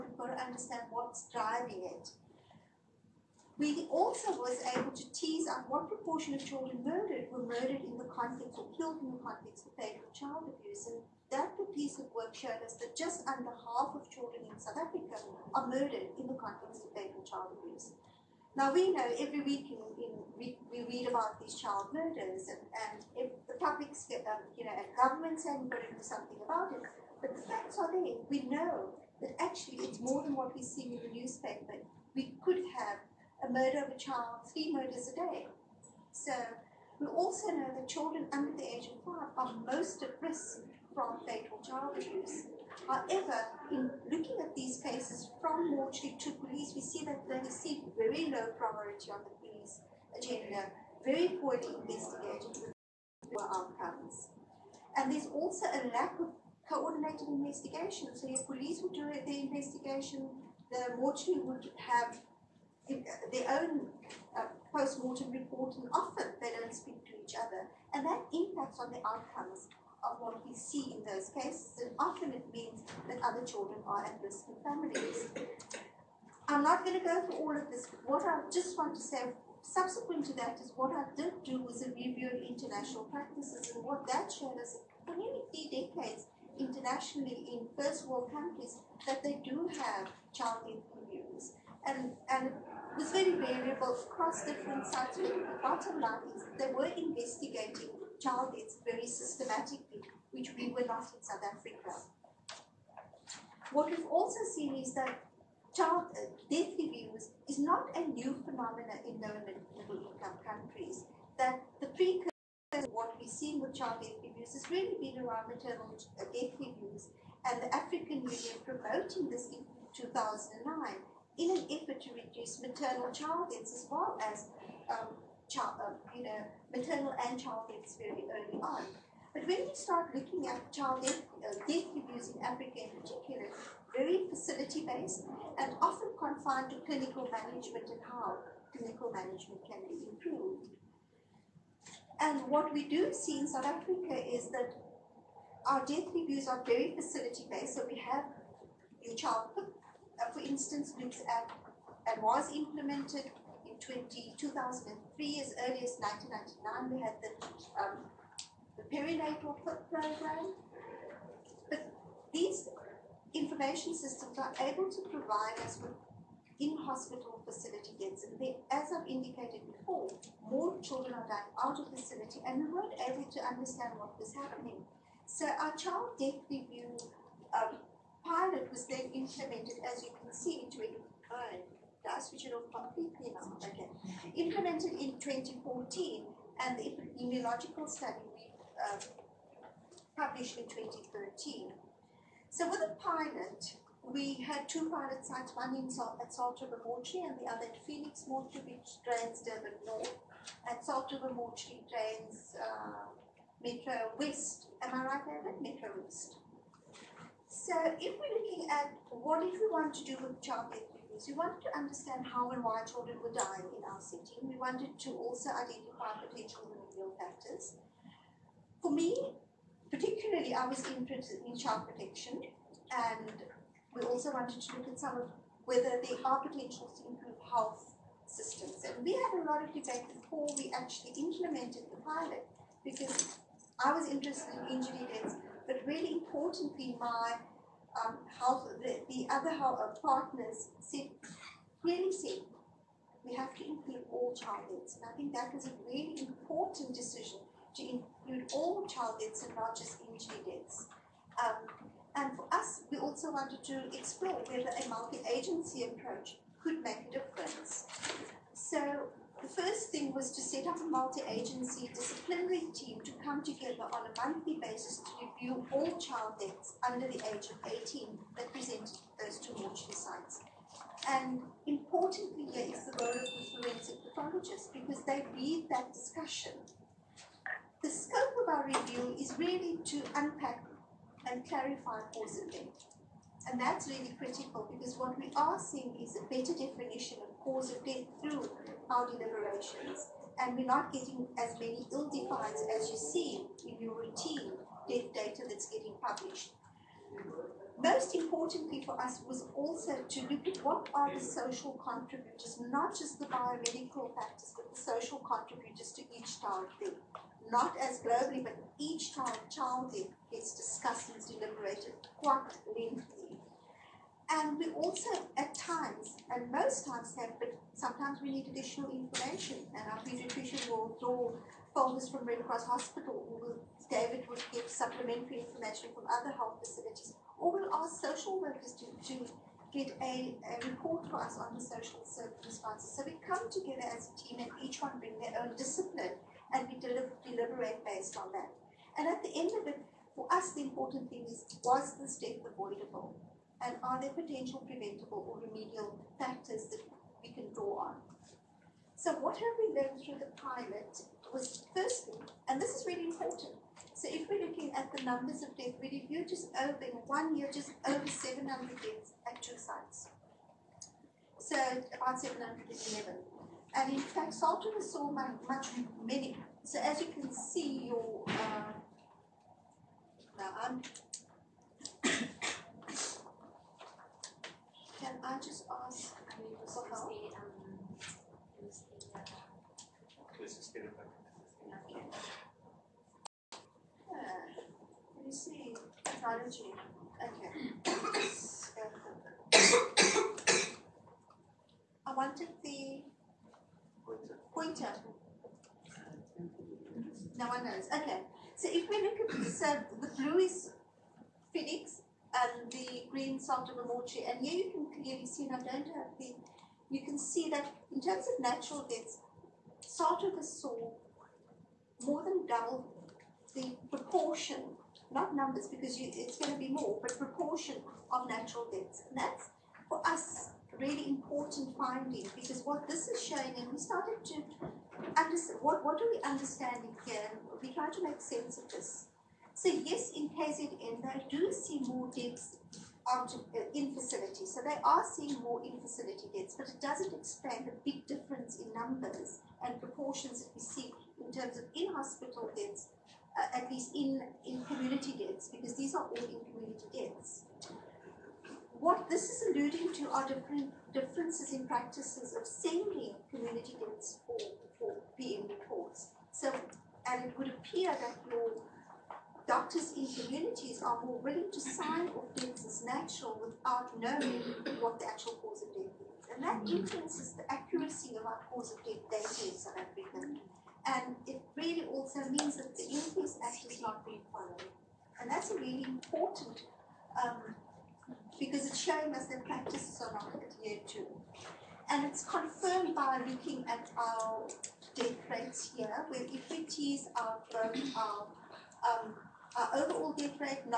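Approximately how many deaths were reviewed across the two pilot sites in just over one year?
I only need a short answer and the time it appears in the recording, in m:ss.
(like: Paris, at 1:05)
711, at 6:02.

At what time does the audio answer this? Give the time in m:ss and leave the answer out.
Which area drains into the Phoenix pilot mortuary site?
3:19.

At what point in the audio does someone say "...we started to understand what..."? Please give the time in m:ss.
7:03.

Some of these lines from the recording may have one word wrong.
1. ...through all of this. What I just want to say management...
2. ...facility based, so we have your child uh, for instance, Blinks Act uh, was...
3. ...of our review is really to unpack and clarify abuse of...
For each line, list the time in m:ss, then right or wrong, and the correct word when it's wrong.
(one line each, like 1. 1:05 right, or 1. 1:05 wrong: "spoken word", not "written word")
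1. 1:17 wrong: "subsequent", not "management"
2. 2:26 right
3. 4:38 wrong: "cause", not "abuse".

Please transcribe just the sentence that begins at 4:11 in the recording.
Um, and for us, we also wanted to explore whether a multi-agency approach could make a difference.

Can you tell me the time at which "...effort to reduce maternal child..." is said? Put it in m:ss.
2:01.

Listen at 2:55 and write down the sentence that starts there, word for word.
So our child death review um, pilot was then implemented, as you can see, in uh, 2009.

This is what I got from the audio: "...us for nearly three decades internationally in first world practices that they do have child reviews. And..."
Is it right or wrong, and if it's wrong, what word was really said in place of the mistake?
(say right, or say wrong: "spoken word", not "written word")
wrong: "countries", not "practices".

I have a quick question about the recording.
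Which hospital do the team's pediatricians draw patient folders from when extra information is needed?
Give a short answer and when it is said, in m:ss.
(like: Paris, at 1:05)
Red Cross Hospital, at 5:22.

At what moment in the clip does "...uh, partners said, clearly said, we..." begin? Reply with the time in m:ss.
3:59.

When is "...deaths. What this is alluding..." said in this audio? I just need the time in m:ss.
7:26.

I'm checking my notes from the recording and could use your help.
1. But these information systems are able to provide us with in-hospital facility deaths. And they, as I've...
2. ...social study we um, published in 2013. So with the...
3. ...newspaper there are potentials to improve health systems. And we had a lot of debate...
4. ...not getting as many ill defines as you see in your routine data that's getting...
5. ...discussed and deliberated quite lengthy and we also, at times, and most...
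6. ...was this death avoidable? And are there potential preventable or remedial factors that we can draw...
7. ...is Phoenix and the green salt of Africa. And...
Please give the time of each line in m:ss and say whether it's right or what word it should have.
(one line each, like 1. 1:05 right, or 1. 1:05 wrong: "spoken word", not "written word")
1. 2:41 right
2. 3:06 wrong: "epidemiological", not "social"
3. 3:45 wrong: "whether", not "newspaper"
4. 4:50 right
5. 5:10 right
6. 5:41 right
7. 6:40 wrong: "Ramochi", not "Africa".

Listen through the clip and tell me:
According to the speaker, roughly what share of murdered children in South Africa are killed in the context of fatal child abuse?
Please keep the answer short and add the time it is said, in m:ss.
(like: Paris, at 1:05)
just under half, at 0:12.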